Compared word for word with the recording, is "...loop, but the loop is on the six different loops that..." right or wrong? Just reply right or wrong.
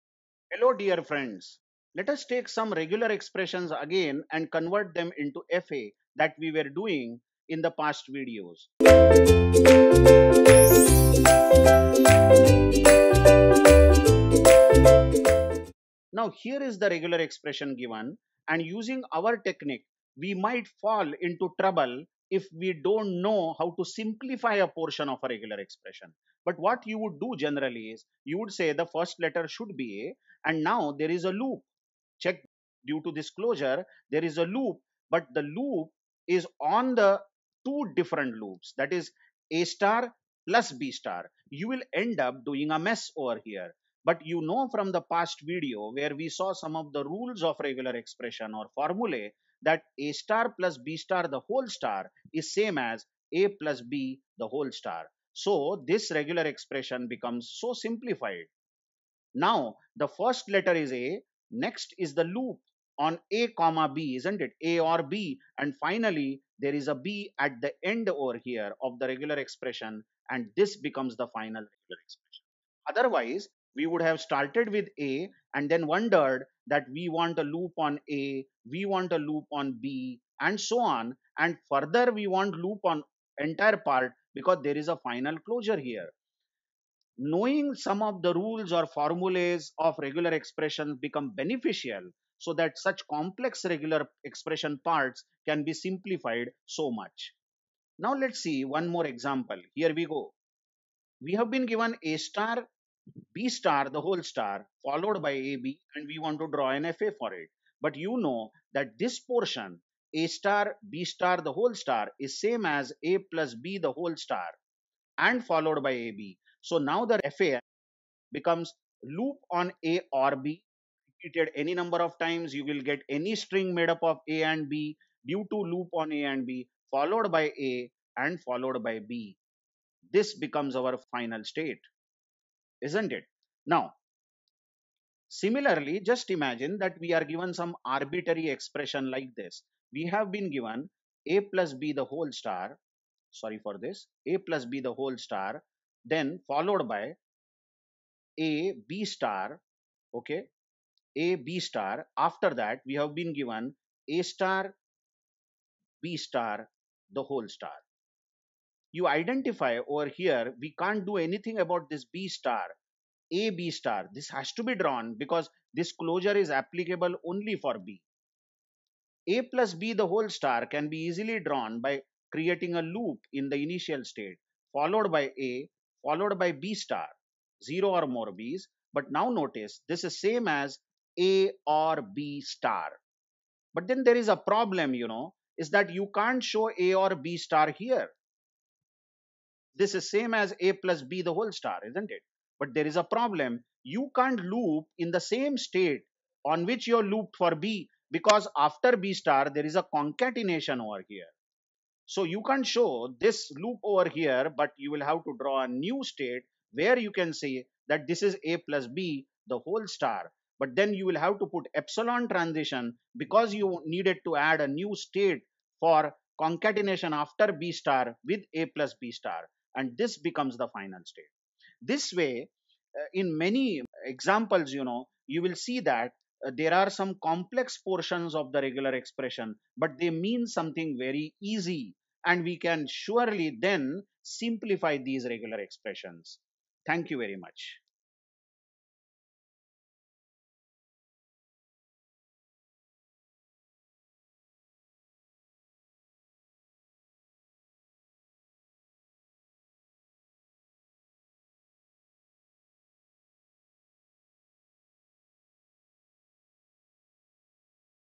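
wrong.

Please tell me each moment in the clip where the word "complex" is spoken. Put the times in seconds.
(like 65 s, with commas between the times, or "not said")
93 s, 227 s.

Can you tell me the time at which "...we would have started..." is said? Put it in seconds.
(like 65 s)
73 s.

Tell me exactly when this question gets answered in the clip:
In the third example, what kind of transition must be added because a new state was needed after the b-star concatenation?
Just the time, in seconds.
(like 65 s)
211 s.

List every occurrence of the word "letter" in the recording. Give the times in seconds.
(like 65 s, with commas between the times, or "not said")
29 s, 60 s.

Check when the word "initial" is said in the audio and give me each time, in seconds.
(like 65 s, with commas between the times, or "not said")
173 s.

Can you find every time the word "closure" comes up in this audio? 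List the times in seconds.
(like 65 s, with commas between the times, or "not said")
33 s, 85 s, 165 s.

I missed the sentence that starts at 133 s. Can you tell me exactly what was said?
Now, similarly, just imagine that we are given some arbitrary expression like this.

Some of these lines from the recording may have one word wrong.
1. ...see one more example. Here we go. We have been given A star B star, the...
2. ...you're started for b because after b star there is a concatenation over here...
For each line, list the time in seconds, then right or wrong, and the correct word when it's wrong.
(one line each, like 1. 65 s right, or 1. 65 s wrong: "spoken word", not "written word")
1. 98 s right
2. 196 s wrong: "looped", not "started".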